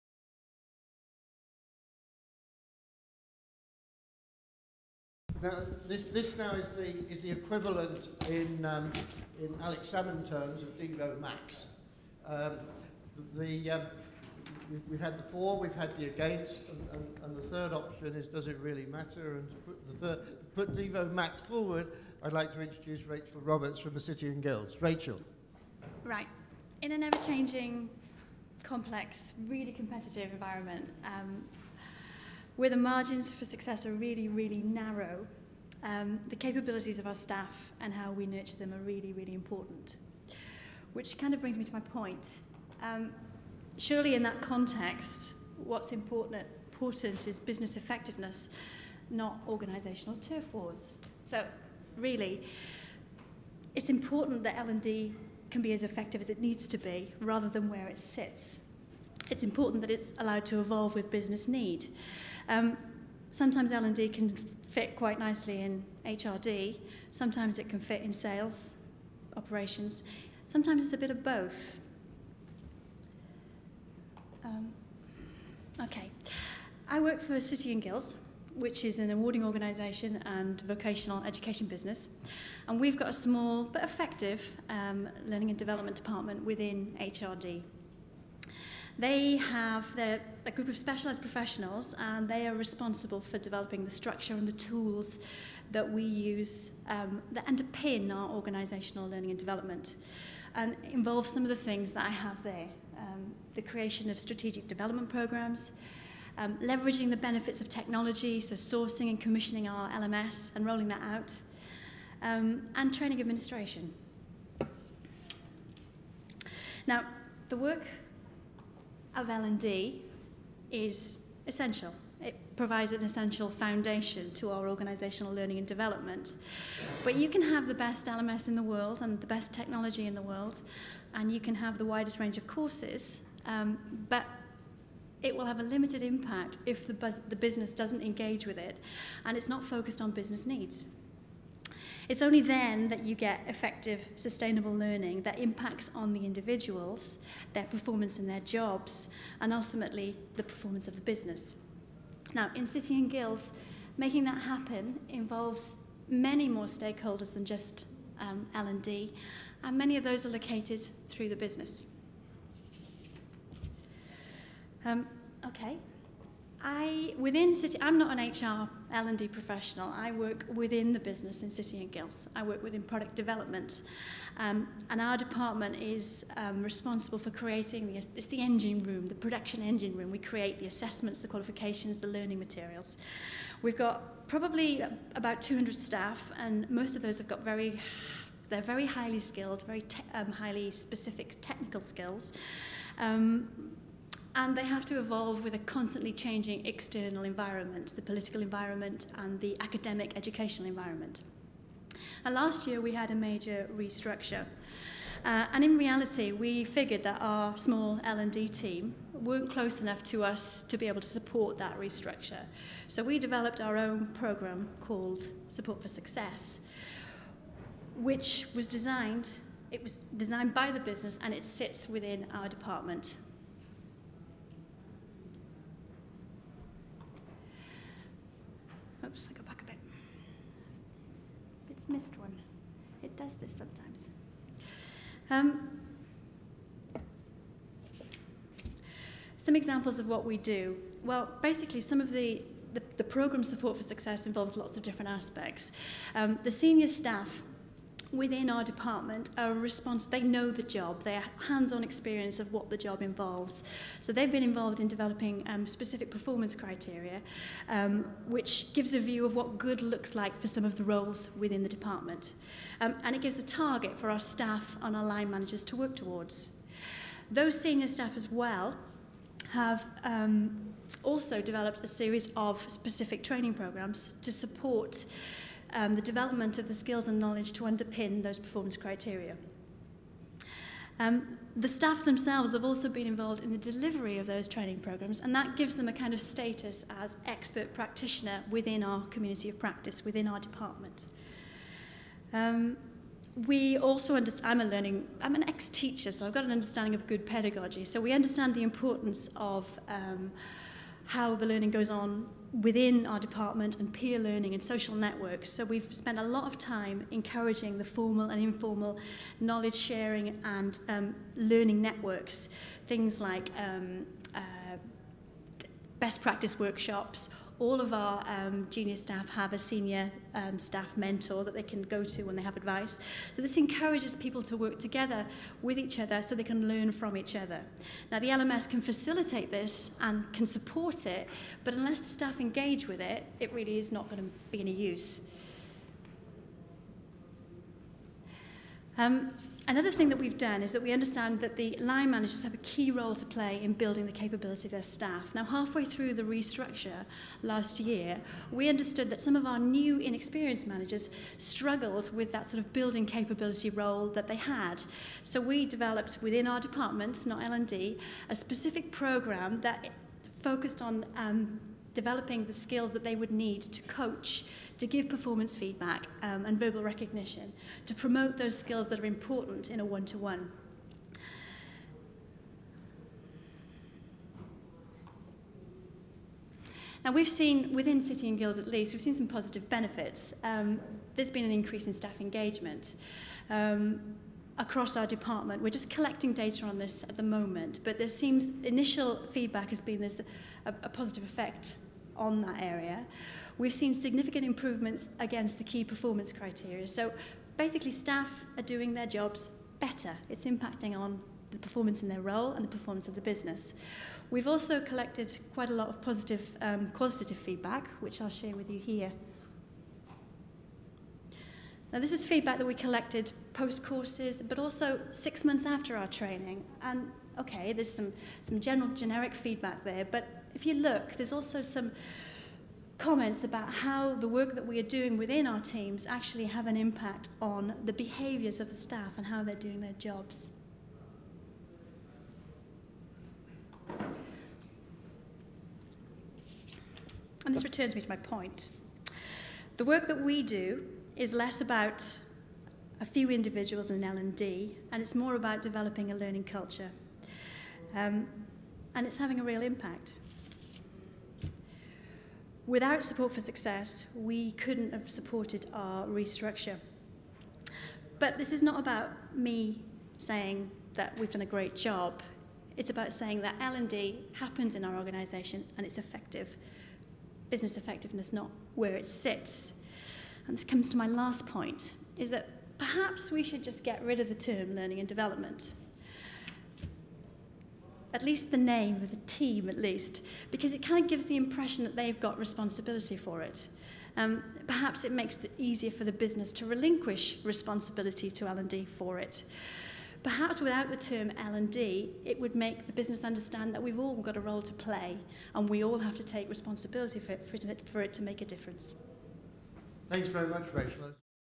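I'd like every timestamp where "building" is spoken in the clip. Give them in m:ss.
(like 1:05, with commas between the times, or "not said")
5:43, 5:52.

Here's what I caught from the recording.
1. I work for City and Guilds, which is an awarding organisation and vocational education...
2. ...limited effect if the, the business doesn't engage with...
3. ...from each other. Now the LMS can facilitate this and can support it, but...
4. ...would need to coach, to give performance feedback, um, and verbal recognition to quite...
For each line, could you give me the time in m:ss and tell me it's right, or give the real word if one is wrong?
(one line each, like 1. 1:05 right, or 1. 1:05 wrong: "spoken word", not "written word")
1. 1:16 right
2. 2:15 wrong: "impact", not "effect"
3. 5:26 right
4. 6:03 wrong: "promote", not "quite".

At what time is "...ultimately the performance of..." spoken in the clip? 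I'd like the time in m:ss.
2:29.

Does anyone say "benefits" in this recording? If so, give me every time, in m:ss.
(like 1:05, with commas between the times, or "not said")
1:47, 6:19.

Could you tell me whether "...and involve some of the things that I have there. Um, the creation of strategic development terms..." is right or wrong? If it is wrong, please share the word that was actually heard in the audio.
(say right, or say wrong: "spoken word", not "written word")
wrong: "programs", not "terms".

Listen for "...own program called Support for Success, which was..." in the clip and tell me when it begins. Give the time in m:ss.
3:33.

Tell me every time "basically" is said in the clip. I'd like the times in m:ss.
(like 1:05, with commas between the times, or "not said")
4:01, 6:37.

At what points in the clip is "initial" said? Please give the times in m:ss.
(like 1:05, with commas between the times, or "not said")
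6:28.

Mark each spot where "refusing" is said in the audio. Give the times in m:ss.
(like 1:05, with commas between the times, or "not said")
not said.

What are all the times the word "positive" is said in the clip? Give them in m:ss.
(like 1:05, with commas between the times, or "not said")
6:19, 6:30, 6:46.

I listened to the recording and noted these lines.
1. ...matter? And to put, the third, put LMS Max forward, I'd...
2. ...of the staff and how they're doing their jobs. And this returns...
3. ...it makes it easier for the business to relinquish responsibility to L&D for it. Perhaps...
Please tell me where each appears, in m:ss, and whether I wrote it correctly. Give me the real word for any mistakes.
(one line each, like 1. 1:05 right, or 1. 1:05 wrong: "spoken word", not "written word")
1. 0:18 wrong: "Devo", not "LMS"
2. 7:08 right
3. 8:05 right.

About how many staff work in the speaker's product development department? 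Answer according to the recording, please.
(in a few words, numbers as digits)
200.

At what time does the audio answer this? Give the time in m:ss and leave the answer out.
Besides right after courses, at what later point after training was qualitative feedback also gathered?
6:55.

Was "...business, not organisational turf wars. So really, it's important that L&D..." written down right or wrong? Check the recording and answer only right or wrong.
wrong.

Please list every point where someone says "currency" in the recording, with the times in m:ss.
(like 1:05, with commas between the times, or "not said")
not said.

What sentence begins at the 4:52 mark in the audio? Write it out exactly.
Um, we also understand, I'm a learning, I'm an ex-teacher, so I've got an understanding of good pedagogy.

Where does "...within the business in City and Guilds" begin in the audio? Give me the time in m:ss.
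2:50.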